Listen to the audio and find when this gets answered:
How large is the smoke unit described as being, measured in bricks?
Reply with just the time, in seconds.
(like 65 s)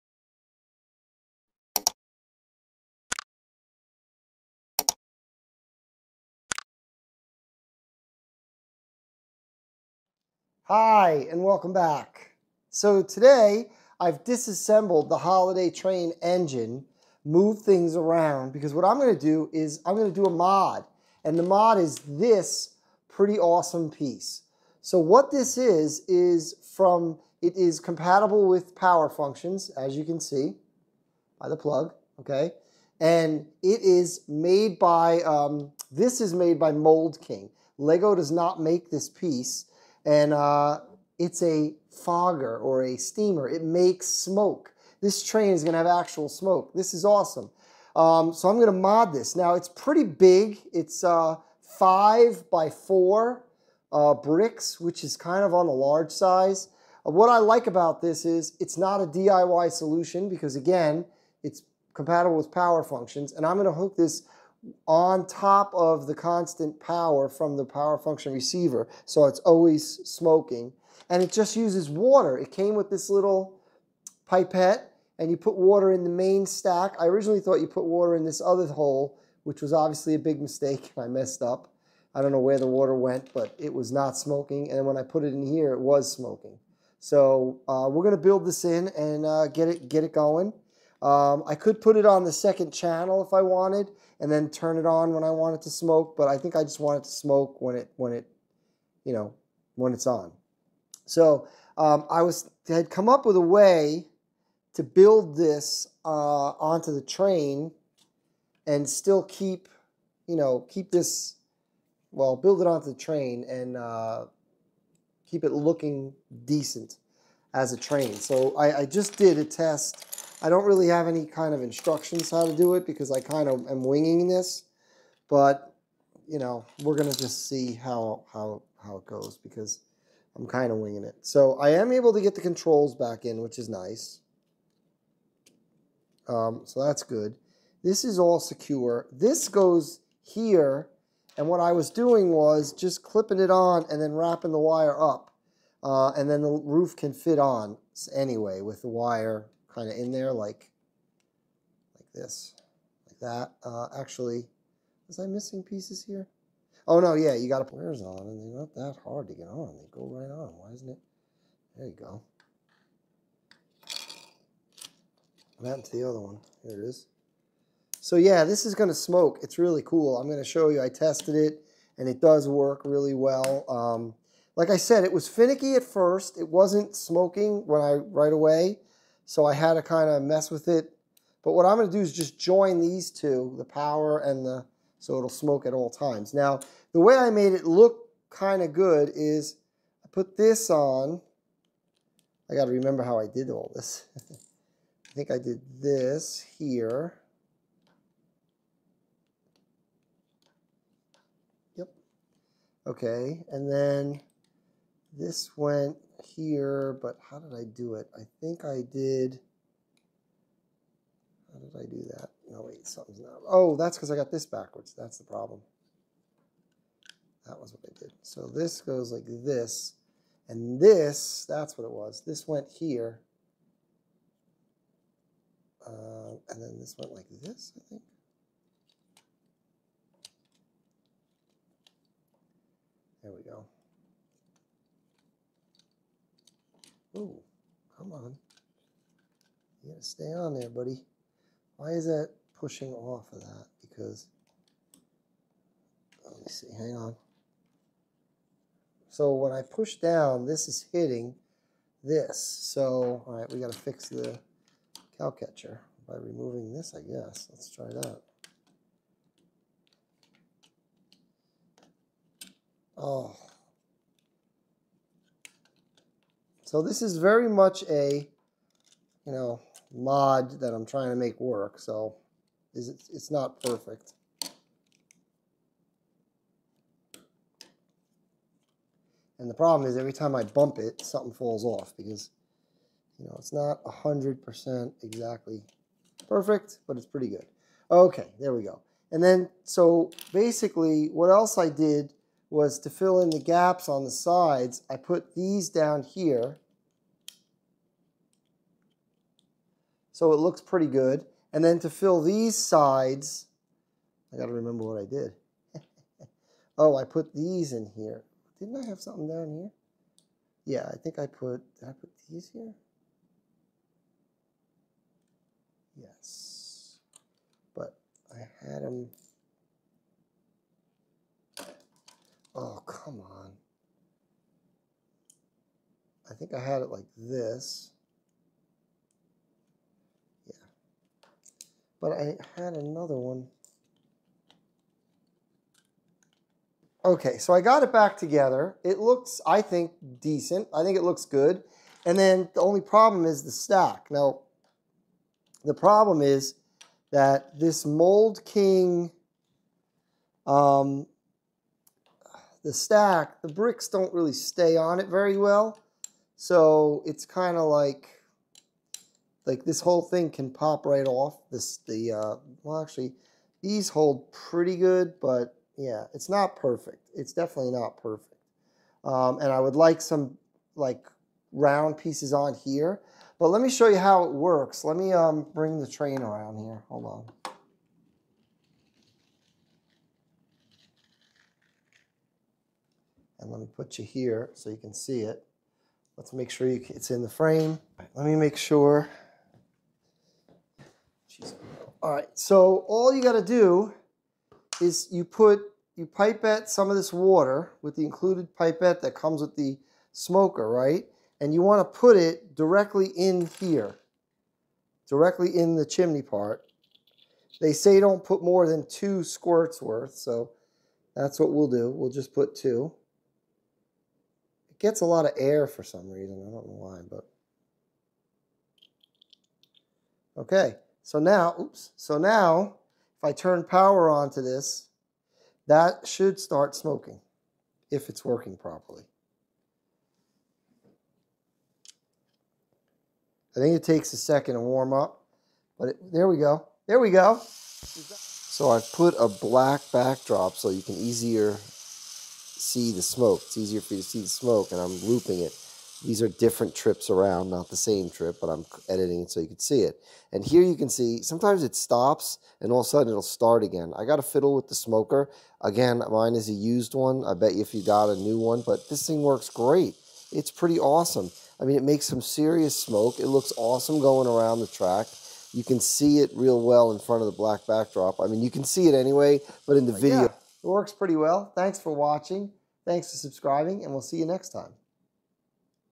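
51 s.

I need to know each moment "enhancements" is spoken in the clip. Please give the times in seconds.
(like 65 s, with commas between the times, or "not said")
not said.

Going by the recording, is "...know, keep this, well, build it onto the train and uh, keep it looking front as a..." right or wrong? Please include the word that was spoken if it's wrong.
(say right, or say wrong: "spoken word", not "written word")
wrong: "decent", not "front".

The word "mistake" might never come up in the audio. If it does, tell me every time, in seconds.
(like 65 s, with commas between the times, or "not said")
80 s.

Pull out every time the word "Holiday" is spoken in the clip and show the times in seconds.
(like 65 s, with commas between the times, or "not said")
15 s.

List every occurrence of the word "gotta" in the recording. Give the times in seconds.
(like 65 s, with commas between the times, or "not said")
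239 s, 253 s, 393 s.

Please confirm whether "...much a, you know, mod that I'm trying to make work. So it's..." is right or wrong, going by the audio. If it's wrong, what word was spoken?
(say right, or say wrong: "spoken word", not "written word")
right.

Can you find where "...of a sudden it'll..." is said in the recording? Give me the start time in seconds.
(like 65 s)
452 s.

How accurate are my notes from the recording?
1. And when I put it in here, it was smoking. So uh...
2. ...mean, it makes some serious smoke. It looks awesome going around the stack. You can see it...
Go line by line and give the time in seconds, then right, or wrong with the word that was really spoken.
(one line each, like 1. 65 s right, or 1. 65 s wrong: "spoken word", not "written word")
1. 84 s right
2. 461 s wrong: "track", not "stack".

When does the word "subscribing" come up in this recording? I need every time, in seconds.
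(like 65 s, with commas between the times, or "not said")
473 s.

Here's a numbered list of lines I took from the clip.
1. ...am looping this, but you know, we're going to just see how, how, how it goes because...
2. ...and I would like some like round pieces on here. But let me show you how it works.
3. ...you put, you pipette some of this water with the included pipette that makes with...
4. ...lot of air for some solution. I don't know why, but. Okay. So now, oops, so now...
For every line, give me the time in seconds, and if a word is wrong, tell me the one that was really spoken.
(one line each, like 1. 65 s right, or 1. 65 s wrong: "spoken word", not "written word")
1. 123 s wrong: "winging", not "looping"
2. 369 s right
3. 395 s wrong: "comes", not "makes"
4. 415 s wrong: "reason", not "solution".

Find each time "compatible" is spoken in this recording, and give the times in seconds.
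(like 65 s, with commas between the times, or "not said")
27 s, 61 s.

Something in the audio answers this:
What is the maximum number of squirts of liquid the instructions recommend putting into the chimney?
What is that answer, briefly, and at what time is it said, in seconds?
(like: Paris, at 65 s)
2, at 408 s.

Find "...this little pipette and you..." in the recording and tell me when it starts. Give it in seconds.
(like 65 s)
72 s.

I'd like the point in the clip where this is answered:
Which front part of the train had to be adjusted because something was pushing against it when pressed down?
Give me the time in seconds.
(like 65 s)
255 s.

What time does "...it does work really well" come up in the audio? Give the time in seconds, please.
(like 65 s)
172 s.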